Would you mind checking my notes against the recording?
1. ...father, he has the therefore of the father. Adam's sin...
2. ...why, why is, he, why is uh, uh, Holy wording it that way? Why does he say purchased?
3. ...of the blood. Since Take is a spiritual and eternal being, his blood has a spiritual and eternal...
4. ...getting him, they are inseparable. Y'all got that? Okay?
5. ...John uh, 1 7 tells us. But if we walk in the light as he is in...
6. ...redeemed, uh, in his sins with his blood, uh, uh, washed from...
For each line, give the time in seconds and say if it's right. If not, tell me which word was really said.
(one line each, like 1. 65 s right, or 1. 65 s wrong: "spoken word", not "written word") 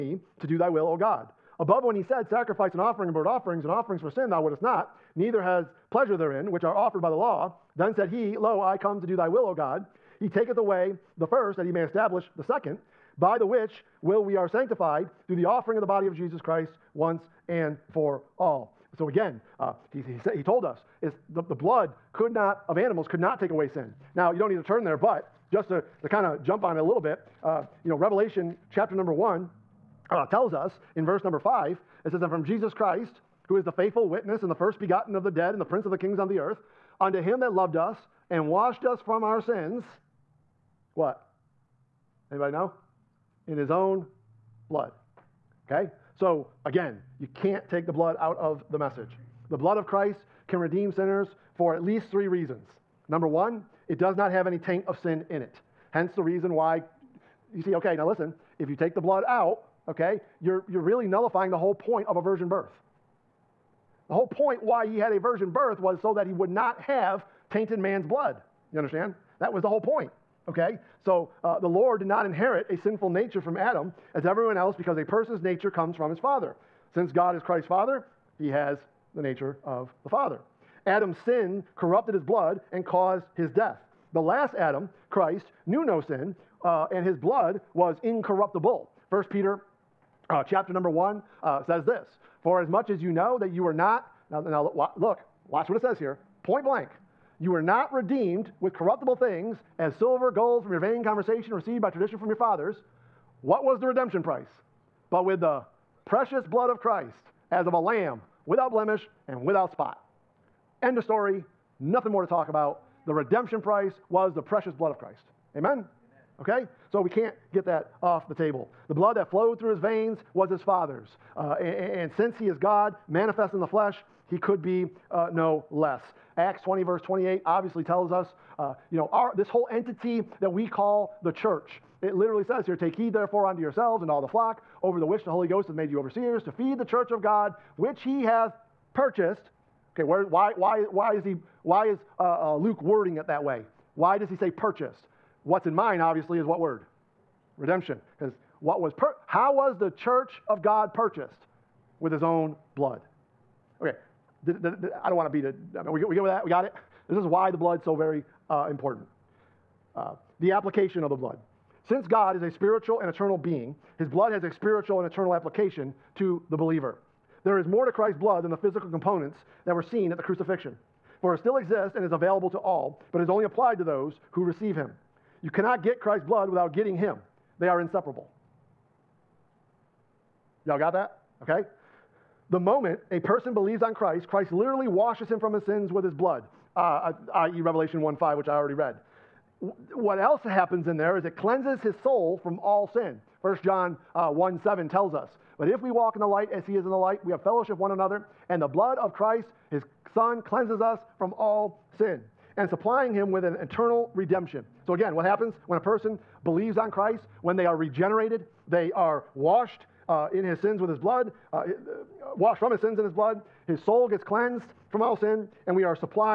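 1. 77 s wrong: "nature", not "therefore"
2. 140 s wrong: "Luke", not "Holy"
3. 161 s wrong: "God", not "Take"
4. 176 s right
5. 193 s right
6. 209 s wrong: "washed", not "redeemed".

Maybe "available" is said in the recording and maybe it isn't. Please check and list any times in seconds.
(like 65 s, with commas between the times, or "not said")
172 s.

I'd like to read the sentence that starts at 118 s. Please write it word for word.
The blood that flowed through his veins was his father's.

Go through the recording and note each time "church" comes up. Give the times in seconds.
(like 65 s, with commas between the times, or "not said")
131 s, 136 s, 150 s.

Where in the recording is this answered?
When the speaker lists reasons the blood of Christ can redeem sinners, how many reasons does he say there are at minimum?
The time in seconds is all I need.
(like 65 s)
52 s.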